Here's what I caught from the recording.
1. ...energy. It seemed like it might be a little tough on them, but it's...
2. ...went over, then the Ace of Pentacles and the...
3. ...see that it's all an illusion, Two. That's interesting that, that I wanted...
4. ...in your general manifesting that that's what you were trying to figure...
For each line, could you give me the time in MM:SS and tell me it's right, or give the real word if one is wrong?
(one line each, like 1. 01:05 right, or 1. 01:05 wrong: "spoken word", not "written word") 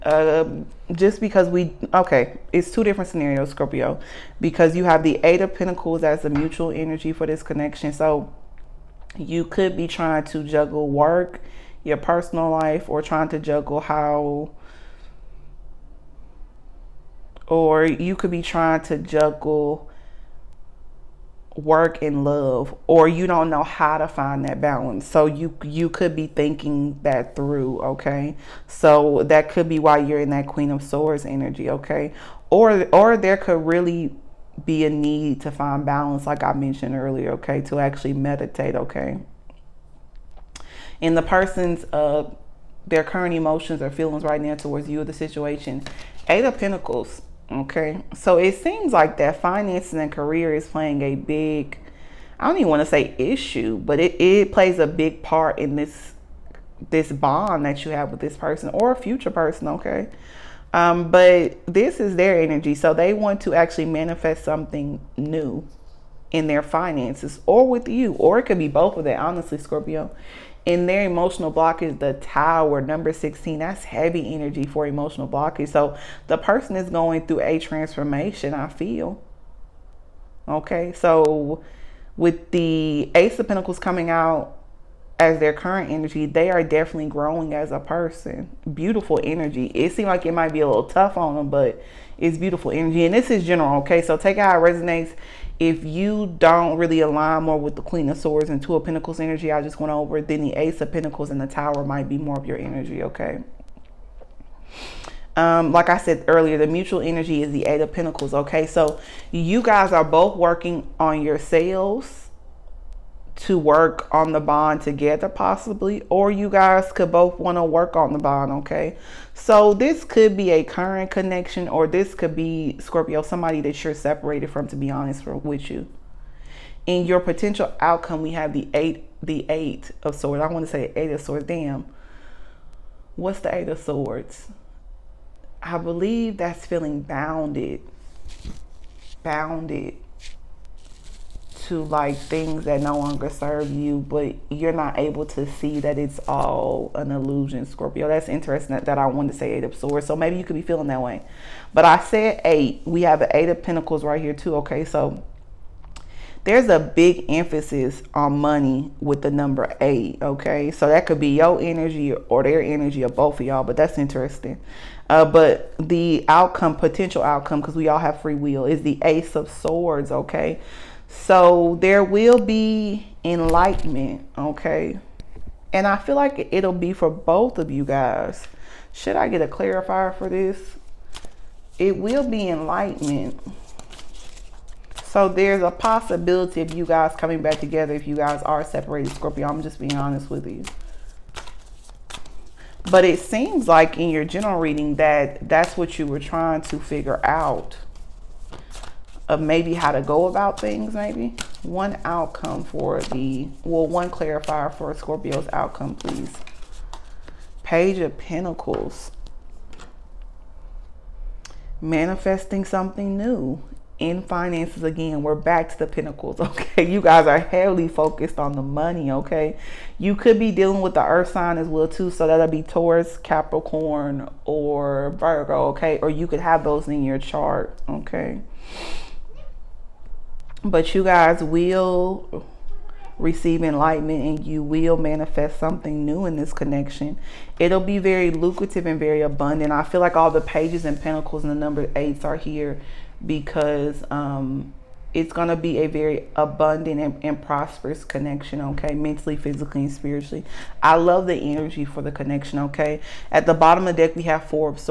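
1. 01:29 right
2. 01:39 right
3. 02:25 wrong: "Scorpio", not "Two"
4. 03:13 wrong: "reading", not "manifesting".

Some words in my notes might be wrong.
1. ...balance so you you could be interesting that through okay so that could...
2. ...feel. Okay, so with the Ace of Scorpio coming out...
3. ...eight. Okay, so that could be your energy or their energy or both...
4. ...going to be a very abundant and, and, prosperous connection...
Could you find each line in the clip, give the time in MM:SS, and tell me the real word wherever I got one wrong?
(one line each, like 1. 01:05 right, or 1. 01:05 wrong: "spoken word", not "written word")
1. 00:24 wrong: "thinking", not "interesting"
2. 01:18 wrong: "Pentacles", not "Scorpio"
3. 02:39 right
4. 04:05 right.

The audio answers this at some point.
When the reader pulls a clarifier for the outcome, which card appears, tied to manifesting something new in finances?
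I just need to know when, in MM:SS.
03:27.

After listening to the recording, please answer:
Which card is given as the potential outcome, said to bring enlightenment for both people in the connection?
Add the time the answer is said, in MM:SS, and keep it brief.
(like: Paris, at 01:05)
Ace of Swords, at 02:49.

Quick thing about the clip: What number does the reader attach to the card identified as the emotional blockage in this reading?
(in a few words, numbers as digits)
16.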